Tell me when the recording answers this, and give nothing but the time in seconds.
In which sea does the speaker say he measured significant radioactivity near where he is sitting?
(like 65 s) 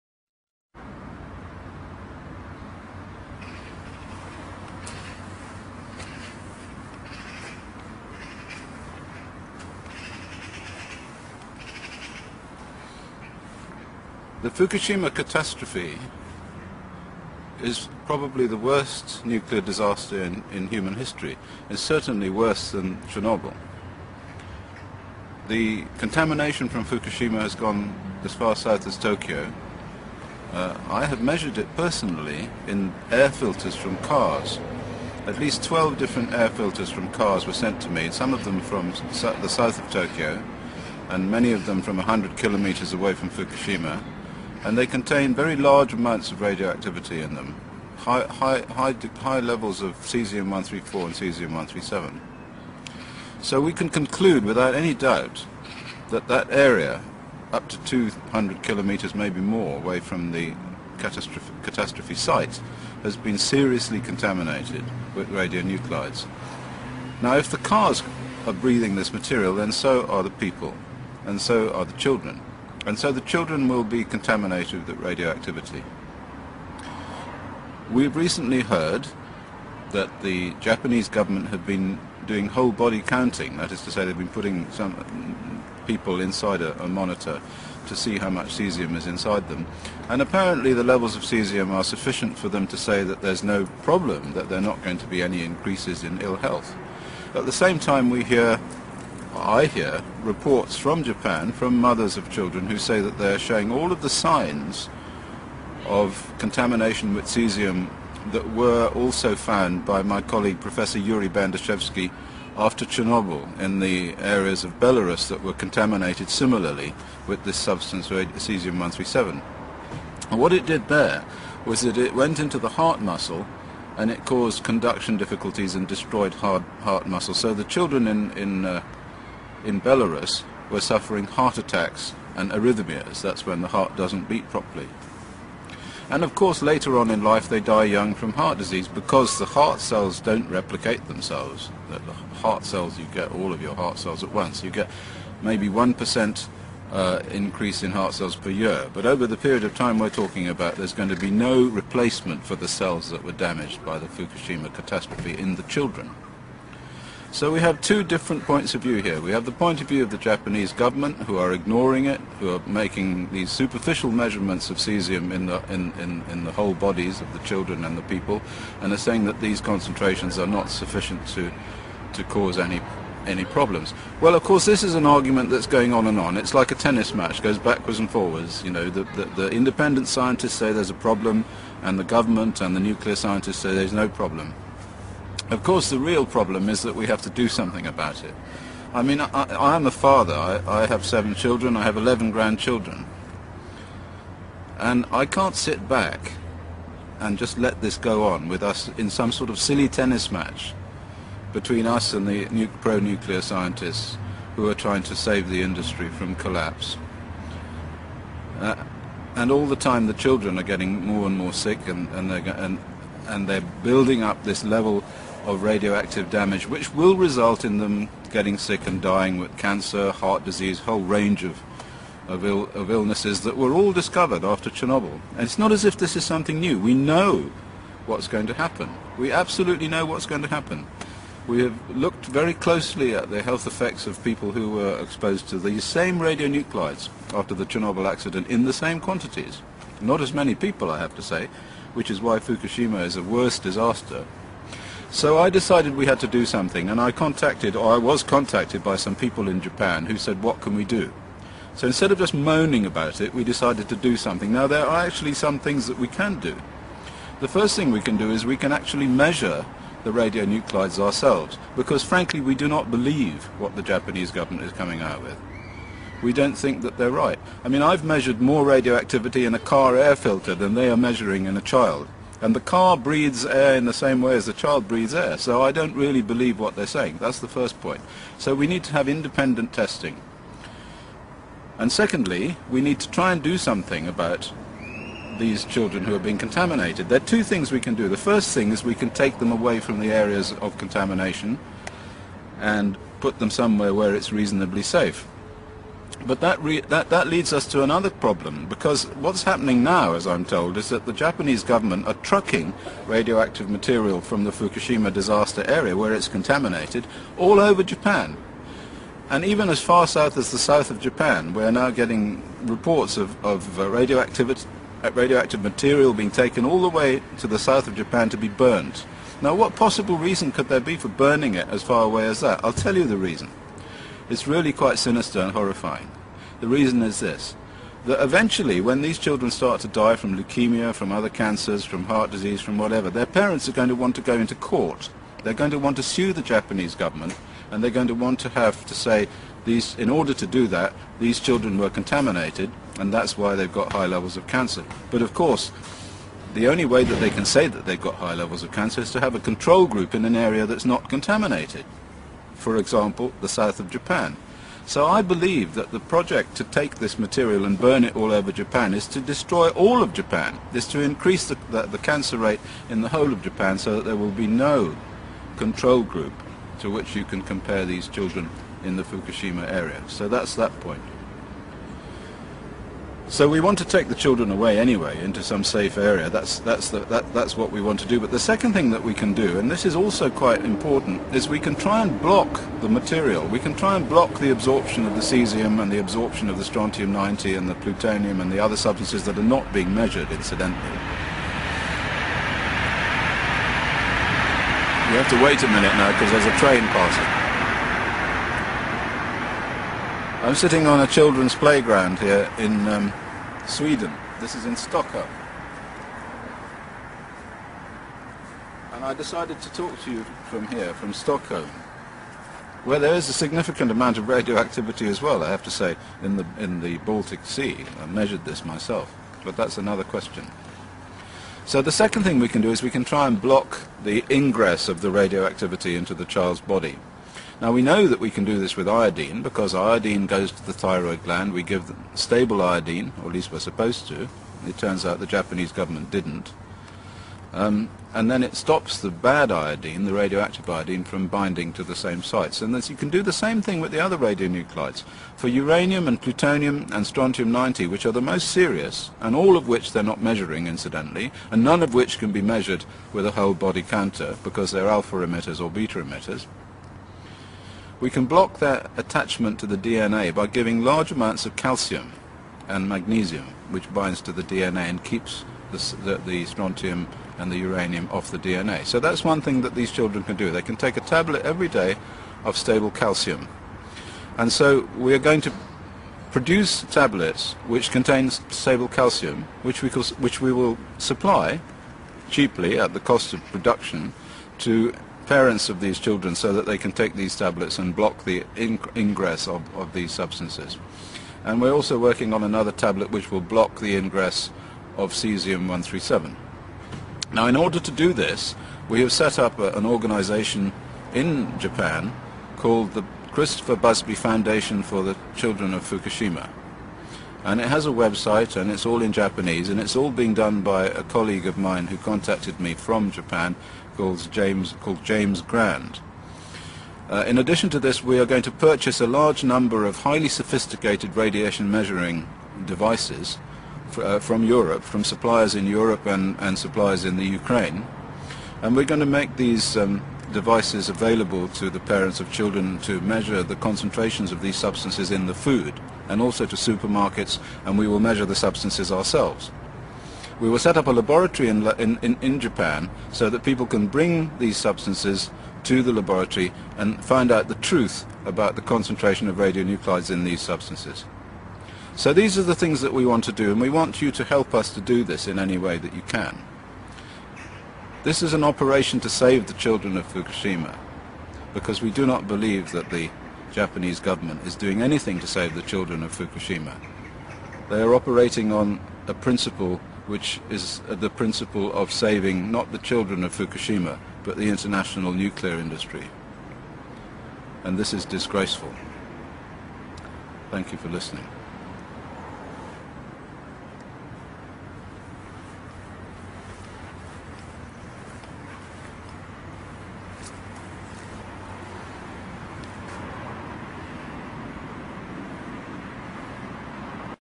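416 s.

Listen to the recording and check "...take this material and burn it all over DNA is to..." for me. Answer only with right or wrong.
wrong.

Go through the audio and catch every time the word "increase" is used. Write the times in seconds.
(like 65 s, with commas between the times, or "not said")
95 s, 147 s, 361 s.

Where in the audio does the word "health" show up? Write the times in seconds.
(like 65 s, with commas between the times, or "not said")
96 s, 233 s.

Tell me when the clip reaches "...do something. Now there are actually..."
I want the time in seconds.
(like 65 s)
253 s.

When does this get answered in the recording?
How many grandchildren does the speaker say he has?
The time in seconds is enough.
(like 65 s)
191 s.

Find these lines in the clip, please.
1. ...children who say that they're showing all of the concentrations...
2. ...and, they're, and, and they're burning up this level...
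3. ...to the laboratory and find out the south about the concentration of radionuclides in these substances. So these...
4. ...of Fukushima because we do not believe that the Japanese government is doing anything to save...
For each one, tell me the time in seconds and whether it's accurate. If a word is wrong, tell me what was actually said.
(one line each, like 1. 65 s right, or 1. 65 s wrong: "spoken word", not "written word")
1. 102 s wrong: "signs", not "concentrations"
2. 212 s wrong: "building", not "burning"
3. 545 s wrong: "truth", not "south"
4. 559 s right.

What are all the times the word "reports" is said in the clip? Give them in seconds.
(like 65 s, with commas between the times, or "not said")
100 s, 312 s.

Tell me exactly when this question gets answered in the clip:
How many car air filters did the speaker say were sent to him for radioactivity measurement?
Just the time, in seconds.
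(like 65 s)
35 s.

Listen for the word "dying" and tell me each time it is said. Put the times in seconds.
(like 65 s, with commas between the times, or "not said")
219 s.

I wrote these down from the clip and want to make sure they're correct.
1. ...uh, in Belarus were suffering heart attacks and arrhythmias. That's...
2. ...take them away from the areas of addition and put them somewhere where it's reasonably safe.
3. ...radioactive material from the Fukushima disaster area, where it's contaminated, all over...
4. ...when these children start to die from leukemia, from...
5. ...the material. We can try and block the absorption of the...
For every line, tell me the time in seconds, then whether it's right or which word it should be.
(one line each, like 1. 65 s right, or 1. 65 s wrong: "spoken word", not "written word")
1. 128 s right
2. 289 s wrong: "contamination", not "addition"
3. 303 s right
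4. 328 s right
5. 382 s right.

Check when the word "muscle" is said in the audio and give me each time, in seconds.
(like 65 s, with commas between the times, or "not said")
123 s, 127 s.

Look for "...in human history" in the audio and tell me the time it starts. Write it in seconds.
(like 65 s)
20 s.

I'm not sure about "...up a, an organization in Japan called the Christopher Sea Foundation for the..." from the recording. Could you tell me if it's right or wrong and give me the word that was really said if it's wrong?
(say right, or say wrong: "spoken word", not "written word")
wrong: "Busby", not "Sea".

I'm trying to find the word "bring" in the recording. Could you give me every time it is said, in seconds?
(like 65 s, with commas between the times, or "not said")
543 s.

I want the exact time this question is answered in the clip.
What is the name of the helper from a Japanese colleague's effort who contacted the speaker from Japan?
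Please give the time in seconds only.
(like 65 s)
515 s.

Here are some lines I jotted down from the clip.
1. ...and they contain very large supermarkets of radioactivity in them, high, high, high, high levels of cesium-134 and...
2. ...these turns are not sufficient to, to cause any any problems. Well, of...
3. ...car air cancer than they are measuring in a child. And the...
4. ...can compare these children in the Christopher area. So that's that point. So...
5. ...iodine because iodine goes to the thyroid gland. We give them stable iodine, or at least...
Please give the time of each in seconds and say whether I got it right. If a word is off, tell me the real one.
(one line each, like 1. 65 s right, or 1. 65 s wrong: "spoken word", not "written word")
1. 44 s wrong: "amounts", not "supermarkets"
2. 169 s wrong: "concentrations", not "turns"
3. 269 s wrong: "filter", not "cancer"
4. 367 s wrong: "Fukushima", not "Christopher"
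5. 428 s right.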